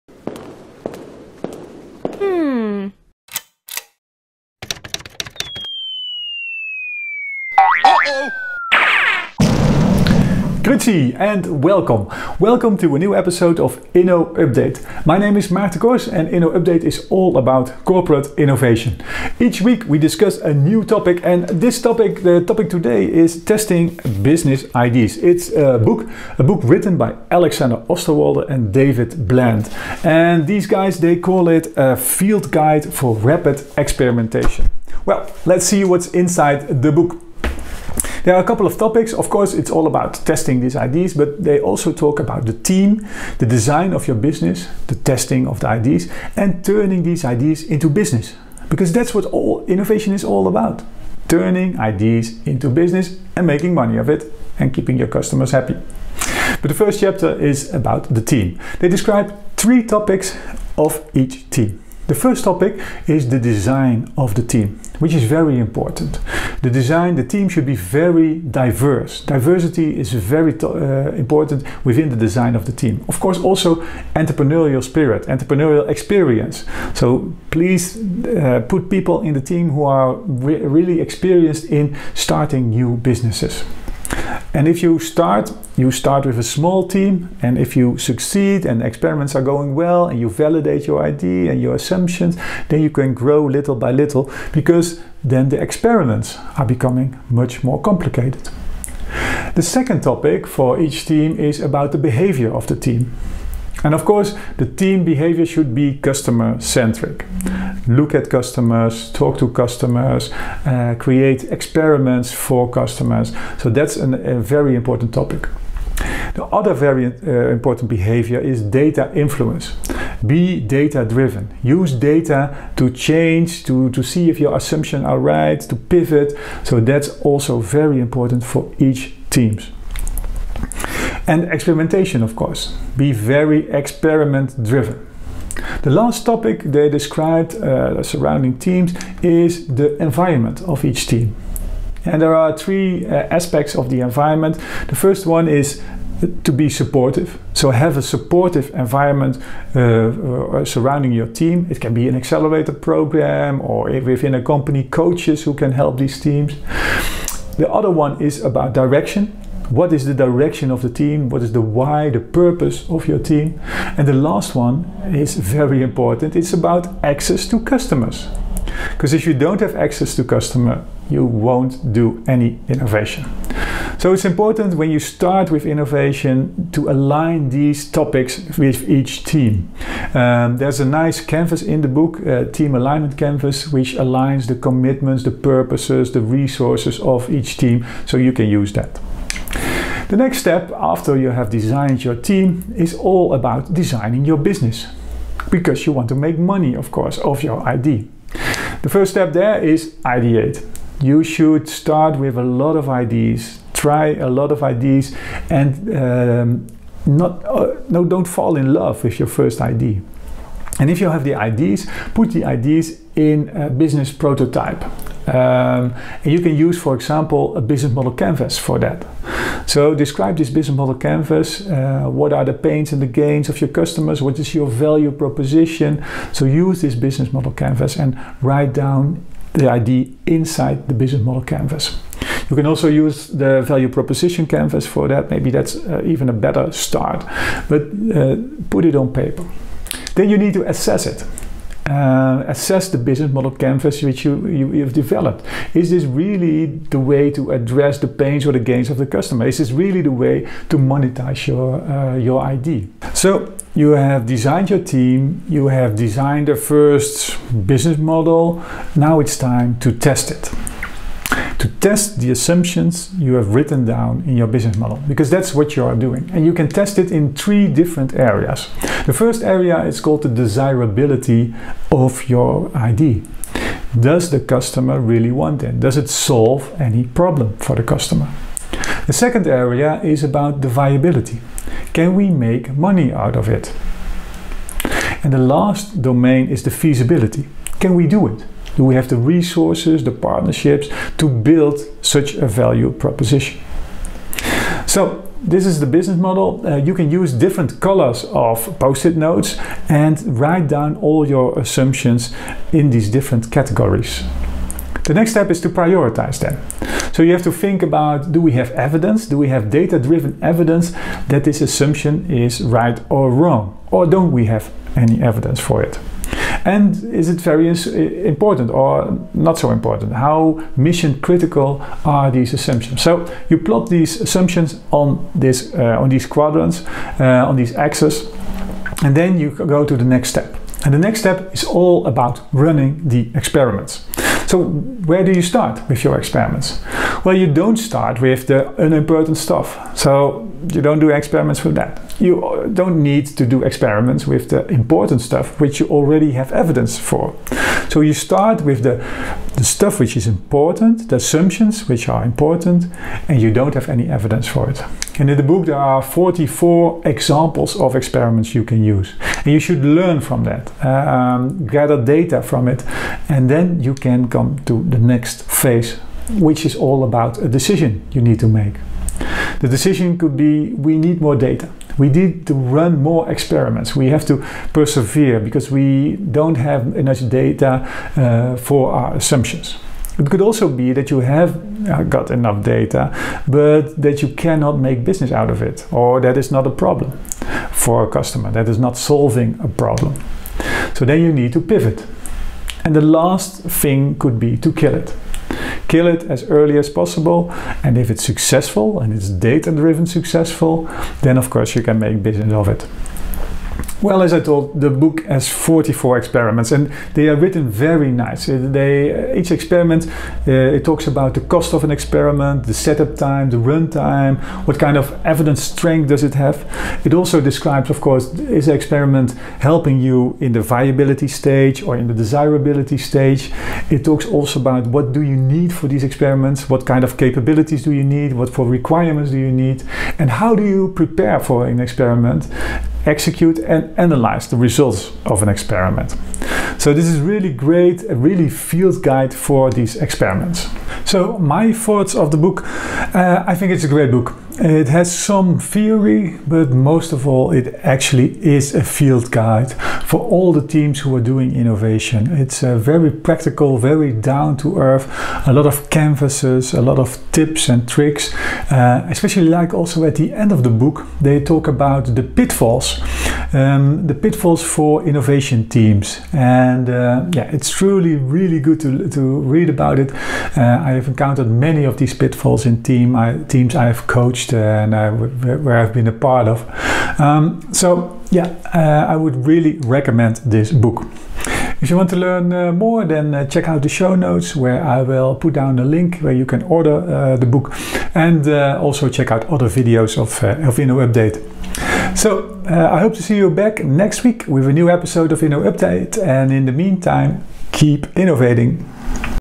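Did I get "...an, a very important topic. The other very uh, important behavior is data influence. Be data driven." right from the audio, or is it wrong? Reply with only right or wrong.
right.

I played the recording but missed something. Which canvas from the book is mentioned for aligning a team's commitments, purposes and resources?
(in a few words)
Team Alignment Canvas.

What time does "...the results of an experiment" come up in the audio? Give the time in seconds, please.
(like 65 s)
434 s.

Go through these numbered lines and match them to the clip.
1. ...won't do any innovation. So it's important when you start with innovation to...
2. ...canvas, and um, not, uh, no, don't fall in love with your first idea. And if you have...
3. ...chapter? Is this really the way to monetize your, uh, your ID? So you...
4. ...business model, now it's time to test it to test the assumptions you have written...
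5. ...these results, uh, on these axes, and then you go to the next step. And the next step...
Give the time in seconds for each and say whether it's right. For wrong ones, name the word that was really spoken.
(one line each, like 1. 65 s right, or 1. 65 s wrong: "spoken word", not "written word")
1. 171 s right
2. 204 s wrong: "ideas", not "canvas"
3. 249 s wrong: "customer", not "chapter"
4. 257 s right
5. 326 s wrong: "quadrants", not "results".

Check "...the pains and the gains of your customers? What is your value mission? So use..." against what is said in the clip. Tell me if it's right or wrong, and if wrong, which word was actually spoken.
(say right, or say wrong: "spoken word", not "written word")
wrong: "proposition", not "mission".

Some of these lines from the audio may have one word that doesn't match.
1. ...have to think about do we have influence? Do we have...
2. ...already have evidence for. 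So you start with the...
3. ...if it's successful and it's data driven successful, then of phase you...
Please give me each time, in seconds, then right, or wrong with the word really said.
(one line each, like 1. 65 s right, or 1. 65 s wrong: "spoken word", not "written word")
1. 307 s wrong: "evidence", not "influence"
2. 345 s right
3. 397 s wrong: "course", not "phase".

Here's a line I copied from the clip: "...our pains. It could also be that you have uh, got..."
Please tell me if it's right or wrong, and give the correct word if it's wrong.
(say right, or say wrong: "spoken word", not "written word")
wrong: "assumptions", not "pains".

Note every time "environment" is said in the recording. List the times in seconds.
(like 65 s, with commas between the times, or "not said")
140 s, 144 s, 148 s.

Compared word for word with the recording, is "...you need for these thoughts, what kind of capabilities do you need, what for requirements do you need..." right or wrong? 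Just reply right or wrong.
wrong.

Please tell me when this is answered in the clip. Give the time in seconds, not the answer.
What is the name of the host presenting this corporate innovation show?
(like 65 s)
15 s.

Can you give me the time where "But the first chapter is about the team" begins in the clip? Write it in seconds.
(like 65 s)
56 s.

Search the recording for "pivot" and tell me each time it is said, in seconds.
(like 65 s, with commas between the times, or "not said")
125 s, 391 s.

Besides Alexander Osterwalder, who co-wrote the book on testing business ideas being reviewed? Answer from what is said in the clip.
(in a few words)
David Bland.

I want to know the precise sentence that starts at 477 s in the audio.
Um, so yeah, uh, I would really recommend this book.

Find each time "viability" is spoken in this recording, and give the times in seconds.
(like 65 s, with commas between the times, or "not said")
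280 s, 420 s.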